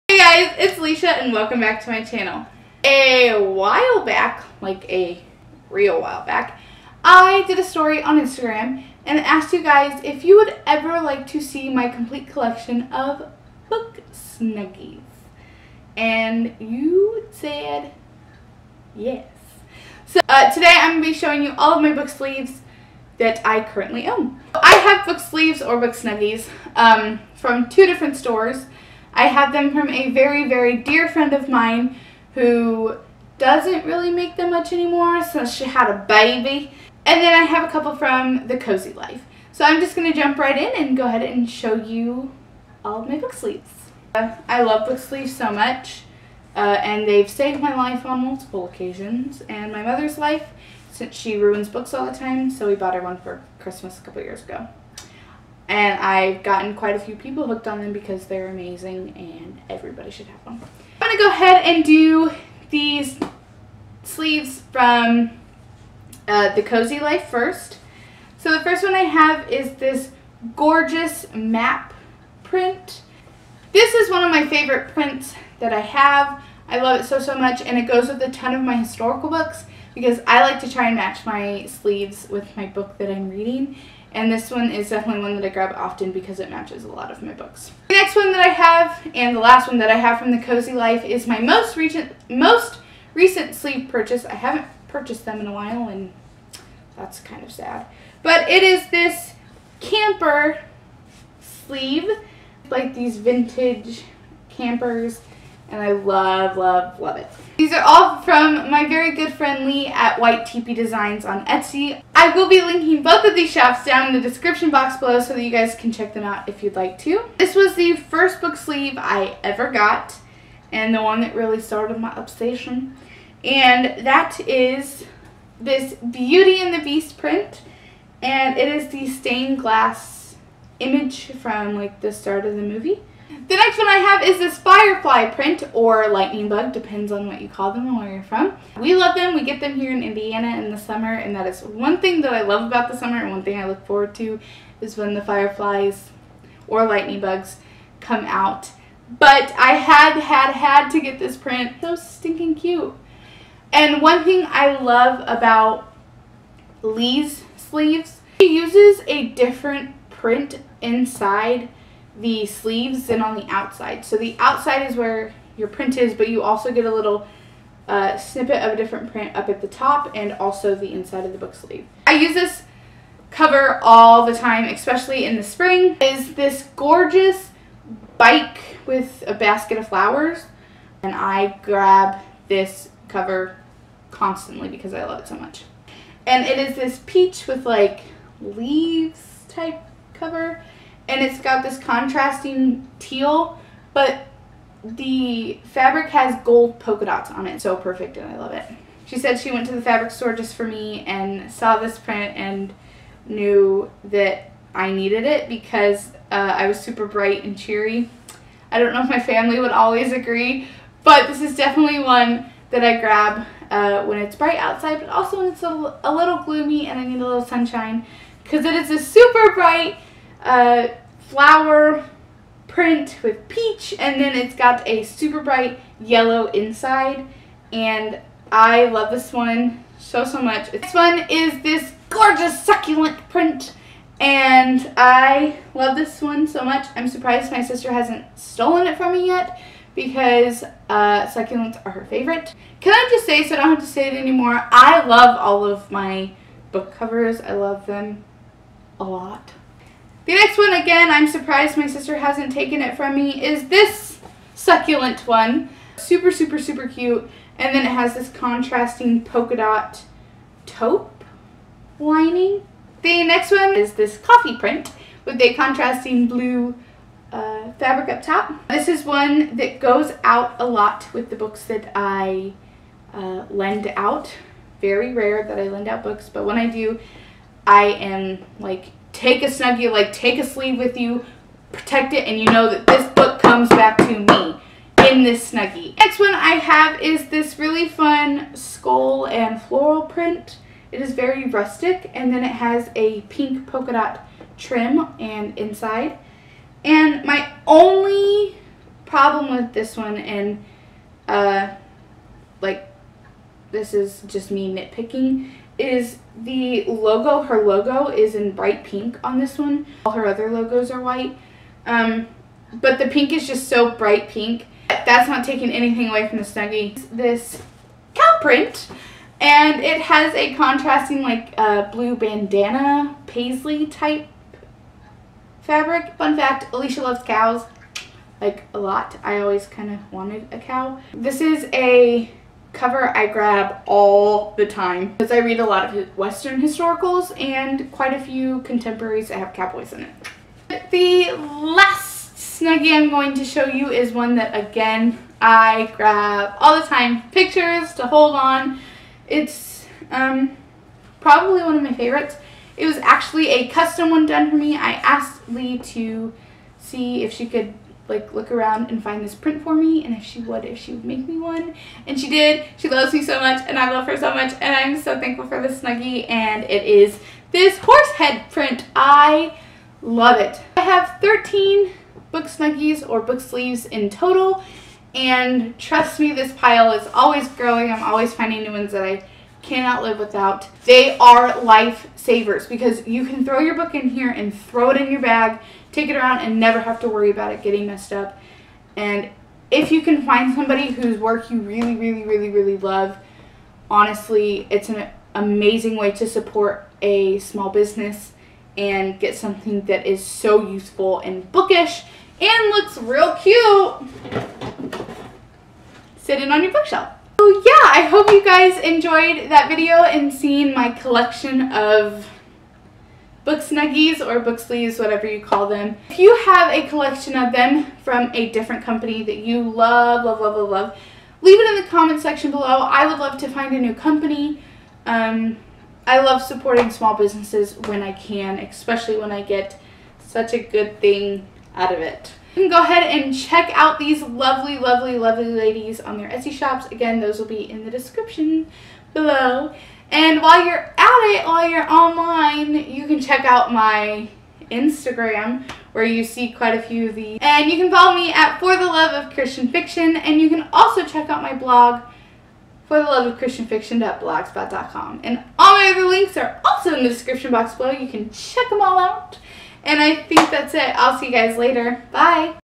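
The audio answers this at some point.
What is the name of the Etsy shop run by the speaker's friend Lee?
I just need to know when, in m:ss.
1:50.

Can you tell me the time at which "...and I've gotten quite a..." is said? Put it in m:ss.
0:55.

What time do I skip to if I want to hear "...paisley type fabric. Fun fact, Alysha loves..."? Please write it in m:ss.
5:23.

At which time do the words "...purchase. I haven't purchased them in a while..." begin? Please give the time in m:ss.
1:33.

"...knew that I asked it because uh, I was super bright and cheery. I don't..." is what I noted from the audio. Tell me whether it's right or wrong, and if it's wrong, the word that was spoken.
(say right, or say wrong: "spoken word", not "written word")
wrong: "needed", not "asked".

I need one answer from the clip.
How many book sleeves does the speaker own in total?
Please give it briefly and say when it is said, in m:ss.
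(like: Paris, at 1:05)
13, at 6:11.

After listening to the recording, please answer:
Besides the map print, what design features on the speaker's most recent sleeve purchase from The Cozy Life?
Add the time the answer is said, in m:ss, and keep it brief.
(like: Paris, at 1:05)
Vintage campers, at 1:43.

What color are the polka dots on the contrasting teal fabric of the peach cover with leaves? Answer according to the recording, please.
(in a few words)
Gold.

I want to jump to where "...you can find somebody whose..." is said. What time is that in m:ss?
6:29.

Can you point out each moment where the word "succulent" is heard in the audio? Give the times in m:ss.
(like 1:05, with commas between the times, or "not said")
3:52, 4:01, 4:14.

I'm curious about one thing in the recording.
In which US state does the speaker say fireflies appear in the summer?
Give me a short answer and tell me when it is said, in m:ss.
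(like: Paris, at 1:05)
Indiana, at 2:20.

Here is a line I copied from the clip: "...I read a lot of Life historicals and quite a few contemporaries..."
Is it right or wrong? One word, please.
wrong.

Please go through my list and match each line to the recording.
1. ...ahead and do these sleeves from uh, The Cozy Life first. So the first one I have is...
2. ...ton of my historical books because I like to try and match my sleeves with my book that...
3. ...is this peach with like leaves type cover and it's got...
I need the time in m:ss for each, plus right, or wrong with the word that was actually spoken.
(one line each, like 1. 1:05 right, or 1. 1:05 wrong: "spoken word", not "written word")
1. 1:01 right
2. 1:18 right
3. 3:06 right.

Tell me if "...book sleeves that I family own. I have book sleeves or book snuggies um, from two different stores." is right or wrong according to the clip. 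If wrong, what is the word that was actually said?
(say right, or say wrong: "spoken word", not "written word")
wrong: "currently", not "family".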